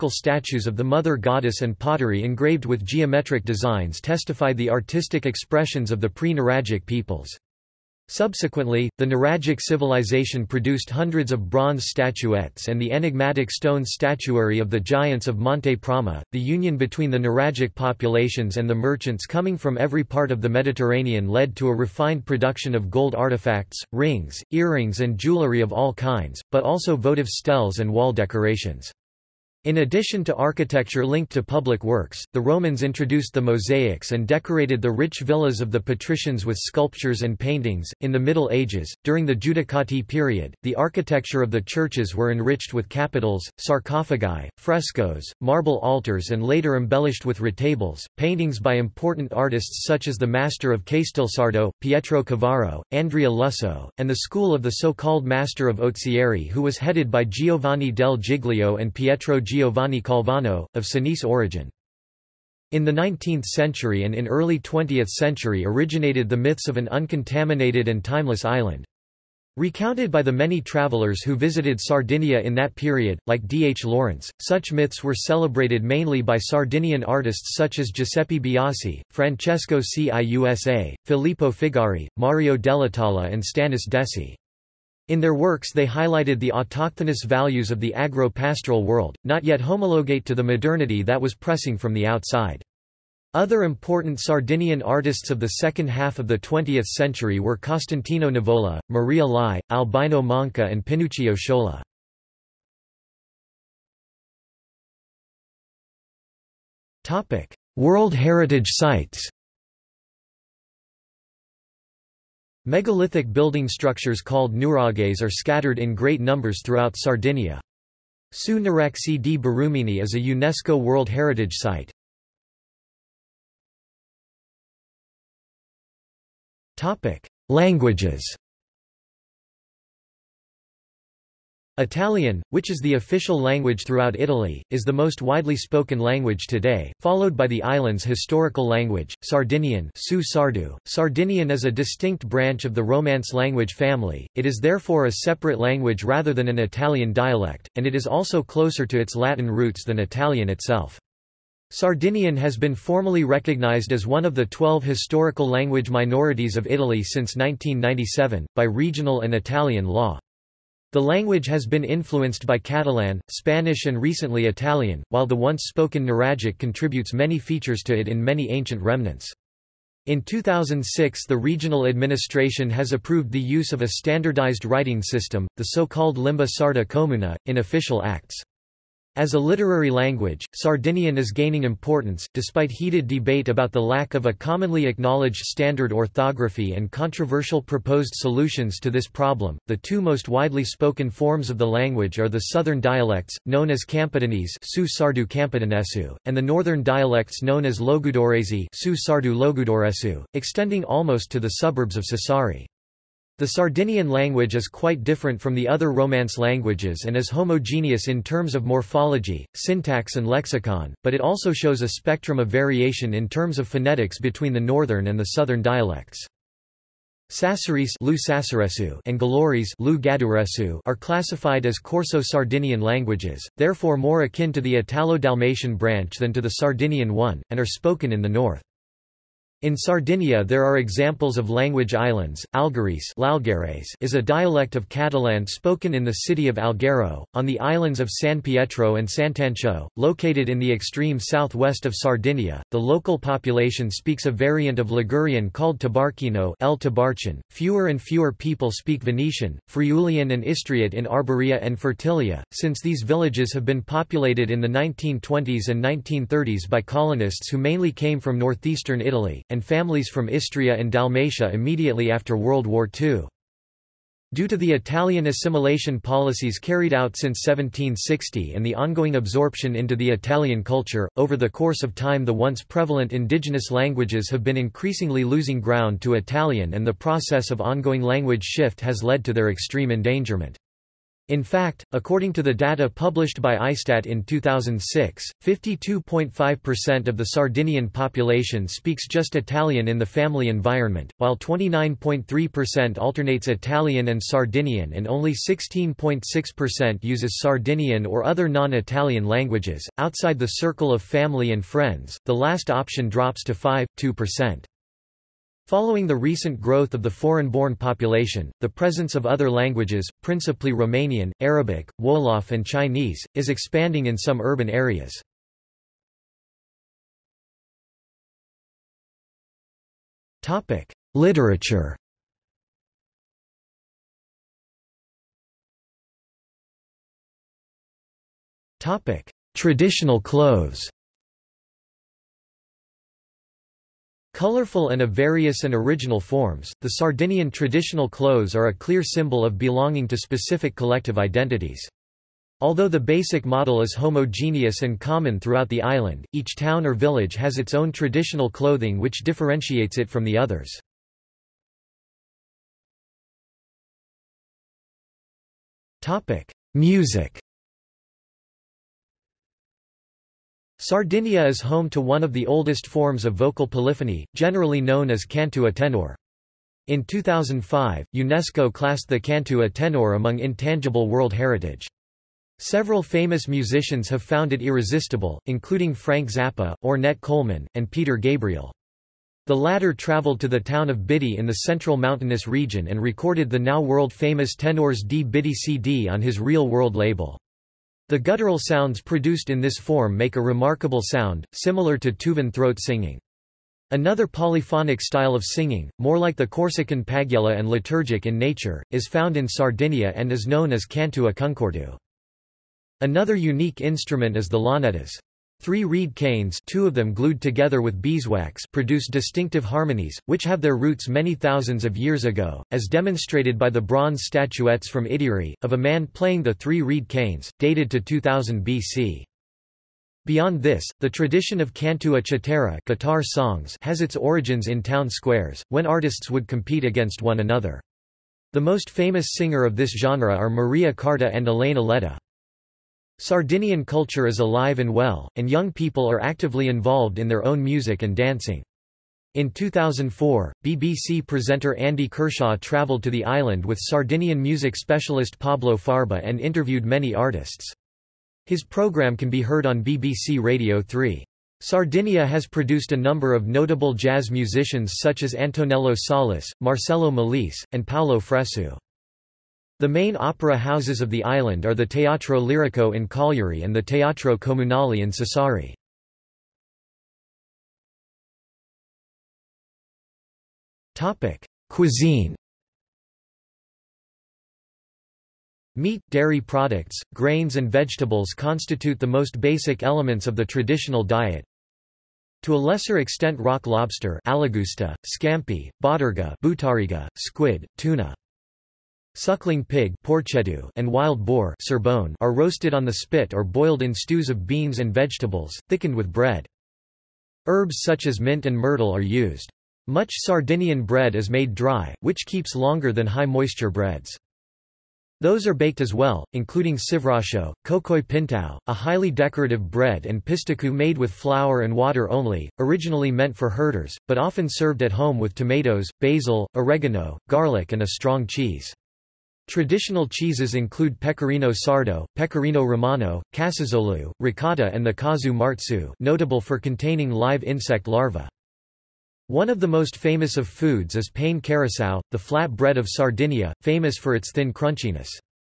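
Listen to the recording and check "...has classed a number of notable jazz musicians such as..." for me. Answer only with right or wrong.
wrong.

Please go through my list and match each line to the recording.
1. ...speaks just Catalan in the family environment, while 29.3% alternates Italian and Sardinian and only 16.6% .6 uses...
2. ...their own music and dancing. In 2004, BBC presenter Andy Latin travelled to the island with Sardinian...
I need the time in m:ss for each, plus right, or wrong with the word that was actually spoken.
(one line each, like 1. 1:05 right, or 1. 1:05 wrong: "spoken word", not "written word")
1. 4:48 wrong: "Italian", not "Catalan"
2. 7:17 wrong: "Kershaw", not "Latin".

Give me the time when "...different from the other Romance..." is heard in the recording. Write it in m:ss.
3:25.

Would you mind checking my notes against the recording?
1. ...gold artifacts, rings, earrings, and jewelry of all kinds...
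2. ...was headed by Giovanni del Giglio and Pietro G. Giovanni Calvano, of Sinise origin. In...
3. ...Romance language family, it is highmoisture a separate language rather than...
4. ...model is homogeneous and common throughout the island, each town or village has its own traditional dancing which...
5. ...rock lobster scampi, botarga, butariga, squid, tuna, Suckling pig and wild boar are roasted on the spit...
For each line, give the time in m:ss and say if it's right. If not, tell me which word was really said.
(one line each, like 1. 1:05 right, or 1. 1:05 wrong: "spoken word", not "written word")
1. 0:22 right
2. 0:56 right
3. 2:22 wrong: "therefore", not "highmoisture"
4. 5:43 wrong: "clothing", not "dancing"
5. 8:03 right.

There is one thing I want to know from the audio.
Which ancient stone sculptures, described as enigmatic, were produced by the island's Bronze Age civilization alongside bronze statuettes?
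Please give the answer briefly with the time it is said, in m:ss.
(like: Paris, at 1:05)
Giants of Monte Prama, at 0:14.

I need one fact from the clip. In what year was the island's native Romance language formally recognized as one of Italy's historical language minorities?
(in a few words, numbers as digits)
1997.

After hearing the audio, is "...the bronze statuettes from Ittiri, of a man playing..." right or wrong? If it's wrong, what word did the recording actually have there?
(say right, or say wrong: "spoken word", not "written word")
right.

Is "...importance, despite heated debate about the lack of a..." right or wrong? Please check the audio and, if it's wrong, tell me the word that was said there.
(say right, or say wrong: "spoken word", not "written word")
right.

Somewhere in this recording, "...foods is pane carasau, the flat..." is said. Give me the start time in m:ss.
8:50.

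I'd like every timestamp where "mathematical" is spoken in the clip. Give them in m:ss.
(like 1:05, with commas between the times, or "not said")
not said.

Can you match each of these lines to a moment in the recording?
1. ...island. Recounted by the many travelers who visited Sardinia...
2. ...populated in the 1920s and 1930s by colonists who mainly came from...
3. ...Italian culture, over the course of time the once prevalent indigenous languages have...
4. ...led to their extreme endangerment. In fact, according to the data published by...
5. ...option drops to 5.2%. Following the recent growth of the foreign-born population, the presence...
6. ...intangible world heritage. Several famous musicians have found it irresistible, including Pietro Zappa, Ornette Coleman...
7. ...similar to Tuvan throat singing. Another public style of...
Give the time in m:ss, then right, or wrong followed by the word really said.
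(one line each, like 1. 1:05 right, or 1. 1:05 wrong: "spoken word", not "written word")
1. 1:08 right
2. 4:13 right
3. 4:30 right
4. 4:39 right
5. 5:02 right
6. 6:10 wrong: "Frank", not "Pietro"
7. 6:31 wrong: "polyphonic", not "public".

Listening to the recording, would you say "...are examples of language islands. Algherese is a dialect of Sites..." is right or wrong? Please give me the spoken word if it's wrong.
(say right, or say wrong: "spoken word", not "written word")
wrong: "Catalan", not "Sites".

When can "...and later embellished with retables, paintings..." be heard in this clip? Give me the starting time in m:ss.
0:46.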